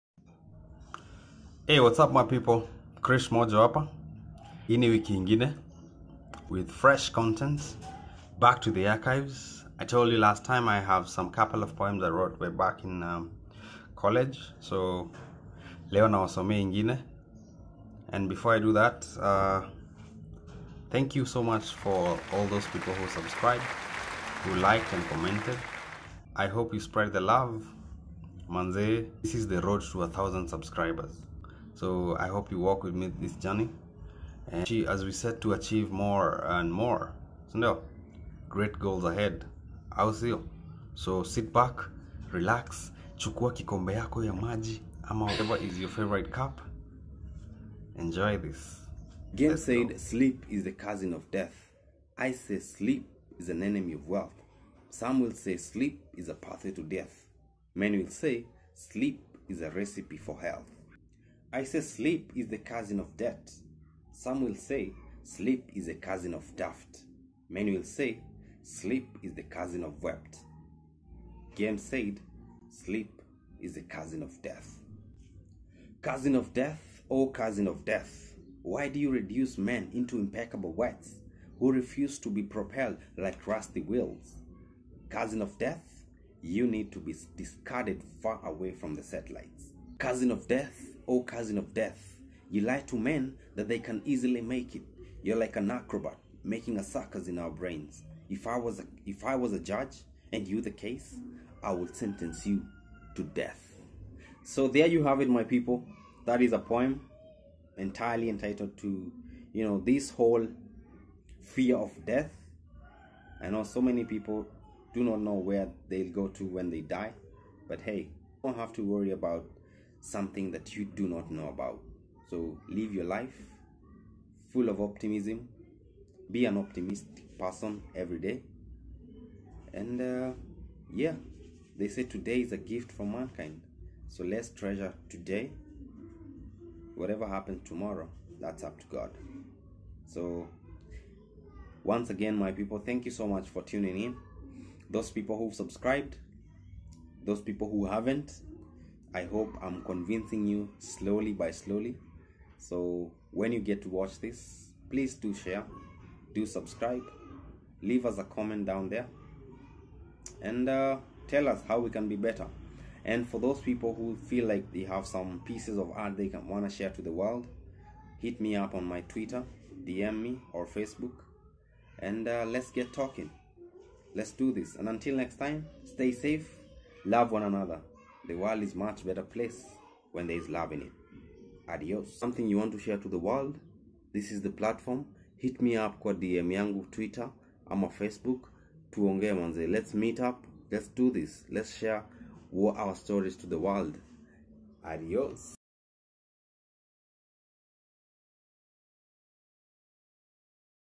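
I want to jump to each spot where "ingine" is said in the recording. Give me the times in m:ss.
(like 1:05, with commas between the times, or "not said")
0:05, 0:16.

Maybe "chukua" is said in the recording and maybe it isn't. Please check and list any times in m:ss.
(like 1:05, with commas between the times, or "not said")
0:43.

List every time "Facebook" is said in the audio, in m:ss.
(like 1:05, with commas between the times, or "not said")
2:50, 3:07.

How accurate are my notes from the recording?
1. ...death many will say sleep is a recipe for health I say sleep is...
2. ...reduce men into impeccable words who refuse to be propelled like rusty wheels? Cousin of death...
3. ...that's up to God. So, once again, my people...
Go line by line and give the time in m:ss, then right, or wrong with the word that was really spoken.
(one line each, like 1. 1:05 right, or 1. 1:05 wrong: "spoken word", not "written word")
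1. 0:56 right
2. 1:19 right
3. 2:18 right.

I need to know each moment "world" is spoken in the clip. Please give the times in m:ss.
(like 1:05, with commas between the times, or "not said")
2:47, 2:58, 3:03, 3:13.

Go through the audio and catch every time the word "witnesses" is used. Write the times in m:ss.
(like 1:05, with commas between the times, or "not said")
not said.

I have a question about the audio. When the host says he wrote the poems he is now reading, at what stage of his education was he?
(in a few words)
college.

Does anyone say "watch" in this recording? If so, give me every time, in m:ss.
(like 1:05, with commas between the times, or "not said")
2:33.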